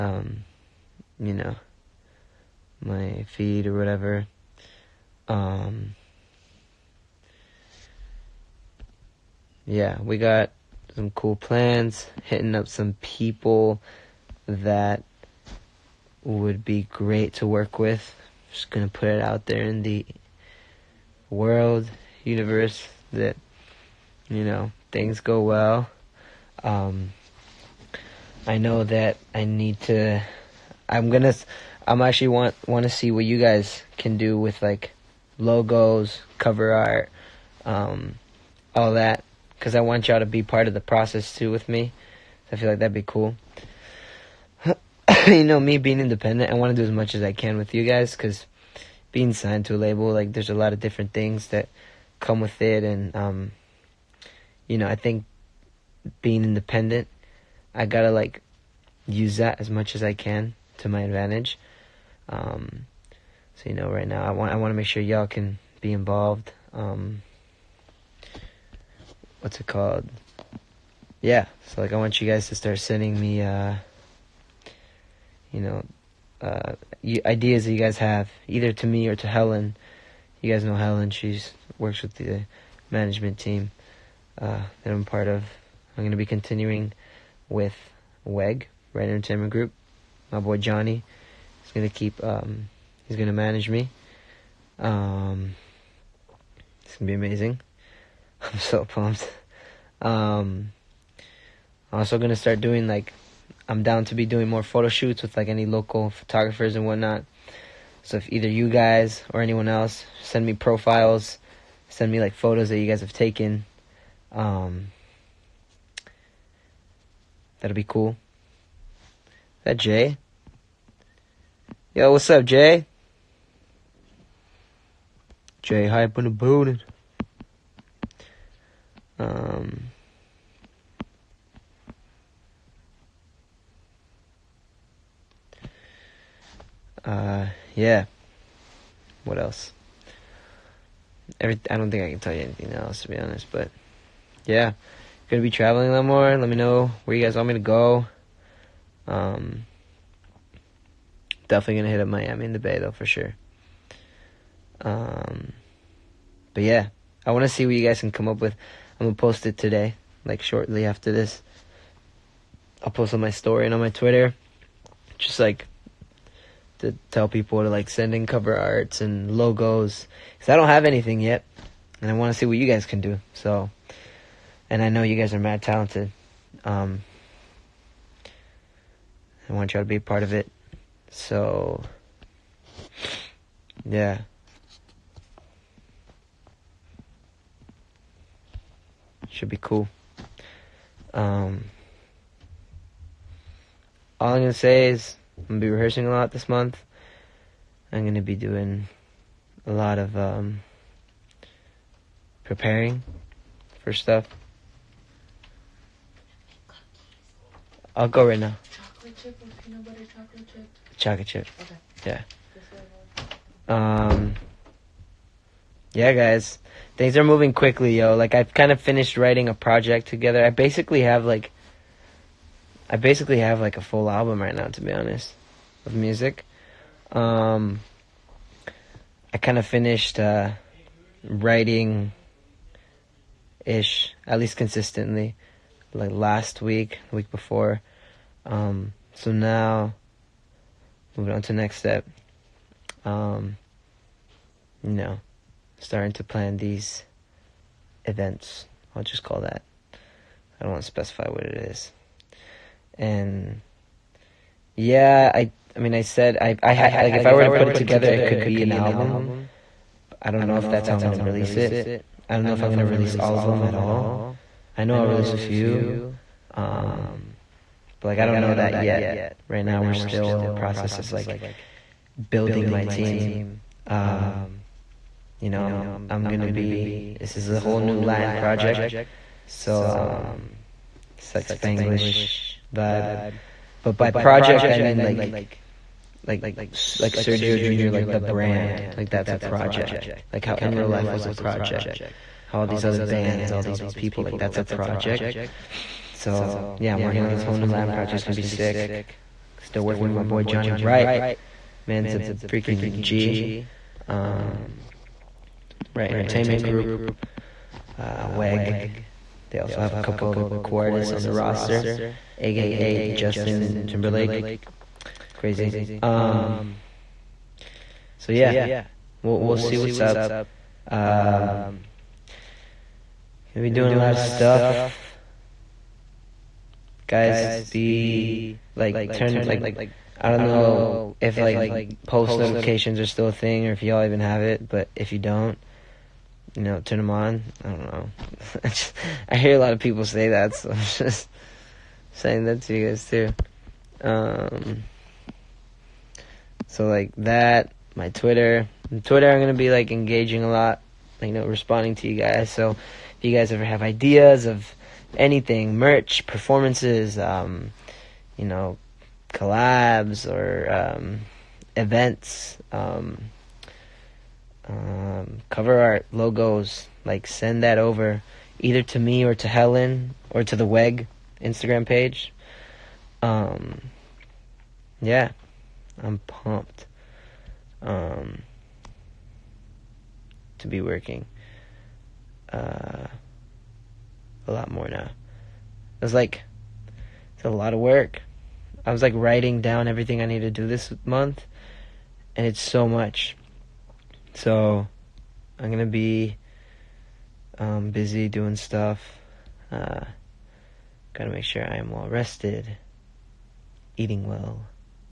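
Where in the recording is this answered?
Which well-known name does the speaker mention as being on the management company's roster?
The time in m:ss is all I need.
5:13.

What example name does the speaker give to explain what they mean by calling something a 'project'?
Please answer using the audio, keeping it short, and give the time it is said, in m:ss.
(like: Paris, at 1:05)
Sergio Junior, at 4:47.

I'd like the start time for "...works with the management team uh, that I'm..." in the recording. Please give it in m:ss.
1:21.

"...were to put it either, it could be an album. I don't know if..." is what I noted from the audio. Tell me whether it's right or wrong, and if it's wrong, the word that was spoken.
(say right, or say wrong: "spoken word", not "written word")
wrong: "together", not "either".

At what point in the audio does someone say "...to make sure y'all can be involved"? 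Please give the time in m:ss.
1:04.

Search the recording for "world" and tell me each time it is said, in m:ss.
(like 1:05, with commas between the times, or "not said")
0:21.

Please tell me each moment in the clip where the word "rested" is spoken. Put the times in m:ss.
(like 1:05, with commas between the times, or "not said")
6:42.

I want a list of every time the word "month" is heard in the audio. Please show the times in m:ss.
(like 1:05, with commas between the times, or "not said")
3:16, 6:31.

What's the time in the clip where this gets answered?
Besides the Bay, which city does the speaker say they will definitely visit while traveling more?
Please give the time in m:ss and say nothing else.
2:32.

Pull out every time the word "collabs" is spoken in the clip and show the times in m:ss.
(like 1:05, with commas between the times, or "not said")
5:59.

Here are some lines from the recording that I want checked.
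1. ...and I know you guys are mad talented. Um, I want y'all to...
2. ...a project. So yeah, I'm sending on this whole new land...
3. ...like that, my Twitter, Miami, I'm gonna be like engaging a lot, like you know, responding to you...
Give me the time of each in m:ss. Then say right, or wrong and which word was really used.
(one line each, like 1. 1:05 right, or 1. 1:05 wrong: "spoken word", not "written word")
1. 2:54 right
2. 4:54 wrong: "working", not "sending"
3. 5:46 wrong: "Twitter", not "Miami".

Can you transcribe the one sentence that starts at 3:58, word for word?
Um, so now, moving on to next step.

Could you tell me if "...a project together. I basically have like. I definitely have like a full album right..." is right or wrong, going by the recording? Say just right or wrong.
wrong.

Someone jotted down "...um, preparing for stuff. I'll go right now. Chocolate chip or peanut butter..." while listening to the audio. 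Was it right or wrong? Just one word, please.
right.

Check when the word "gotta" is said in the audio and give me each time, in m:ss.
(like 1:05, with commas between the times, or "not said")
0:57, 6:41.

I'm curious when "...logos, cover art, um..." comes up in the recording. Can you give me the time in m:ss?
0:35.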